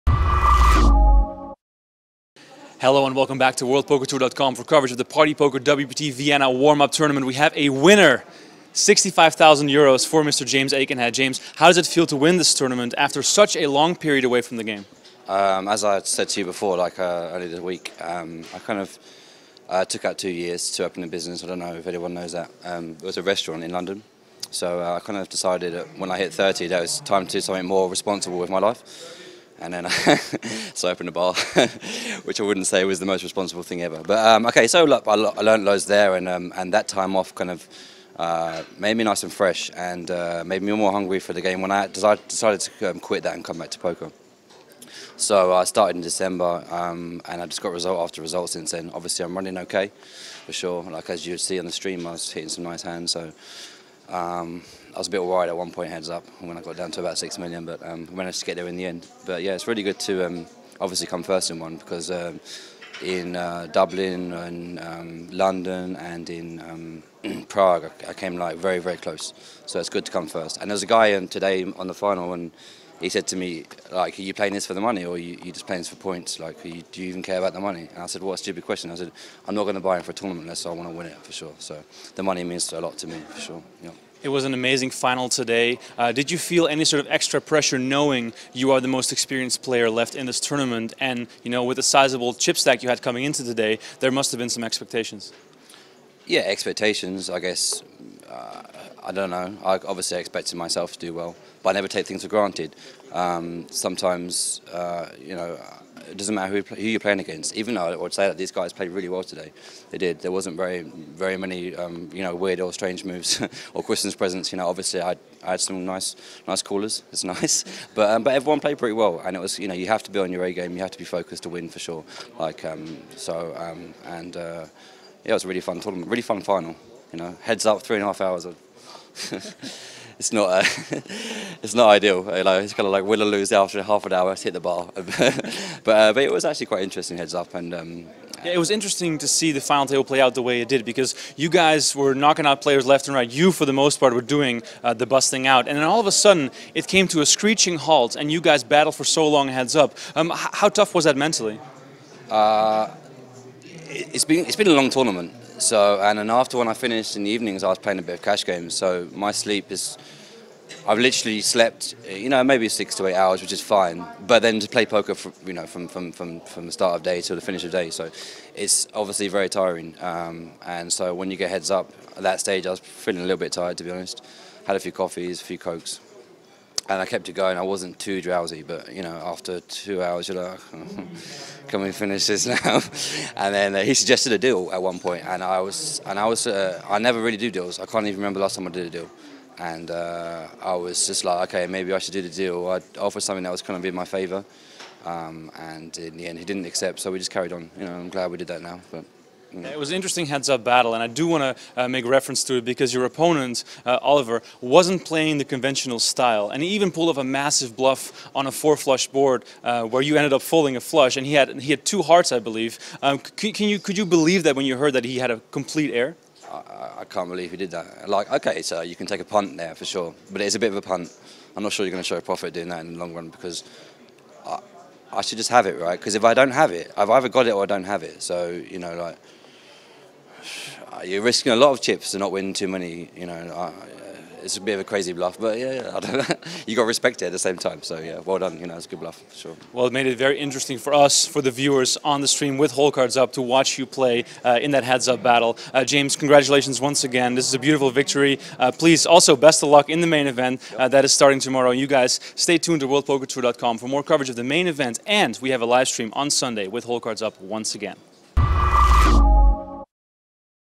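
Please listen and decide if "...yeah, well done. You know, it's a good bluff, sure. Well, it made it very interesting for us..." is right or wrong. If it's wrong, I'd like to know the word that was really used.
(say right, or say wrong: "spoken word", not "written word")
right.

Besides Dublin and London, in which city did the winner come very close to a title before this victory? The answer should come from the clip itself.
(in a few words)
Prague.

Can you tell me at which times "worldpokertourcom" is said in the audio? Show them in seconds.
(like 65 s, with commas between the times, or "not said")
3 s, 252 s.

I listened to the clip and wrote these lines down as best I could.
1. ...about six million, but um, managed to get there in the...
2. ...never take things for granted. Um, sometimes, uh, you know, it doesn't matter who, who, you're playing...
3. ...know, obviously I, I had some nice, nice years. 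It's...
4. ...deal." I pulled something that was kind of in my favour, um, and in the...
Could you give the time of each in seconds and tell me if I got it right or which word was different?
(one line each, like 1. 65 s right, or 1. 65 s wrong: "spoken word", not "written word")
1. 56 s right
2. 101 s right
3. 114 s wrong: "callers", not "years"
4. 192 s wrong: "offered", not "pulled".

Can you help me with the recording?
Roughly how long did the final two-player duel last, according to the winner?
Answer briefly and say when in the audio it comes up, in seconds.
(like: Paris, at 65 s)
3.5 hours, at 127 s.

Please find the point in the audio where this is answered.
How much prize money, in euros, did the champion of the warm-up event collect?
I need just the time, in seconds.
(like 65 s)
8 s.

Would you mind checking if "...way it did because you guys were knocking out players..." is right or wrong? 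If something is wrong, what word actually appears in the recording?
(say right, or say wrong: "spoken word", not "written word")
right.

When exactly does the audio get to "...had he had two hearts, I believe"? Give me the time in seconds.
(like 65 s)
211 s.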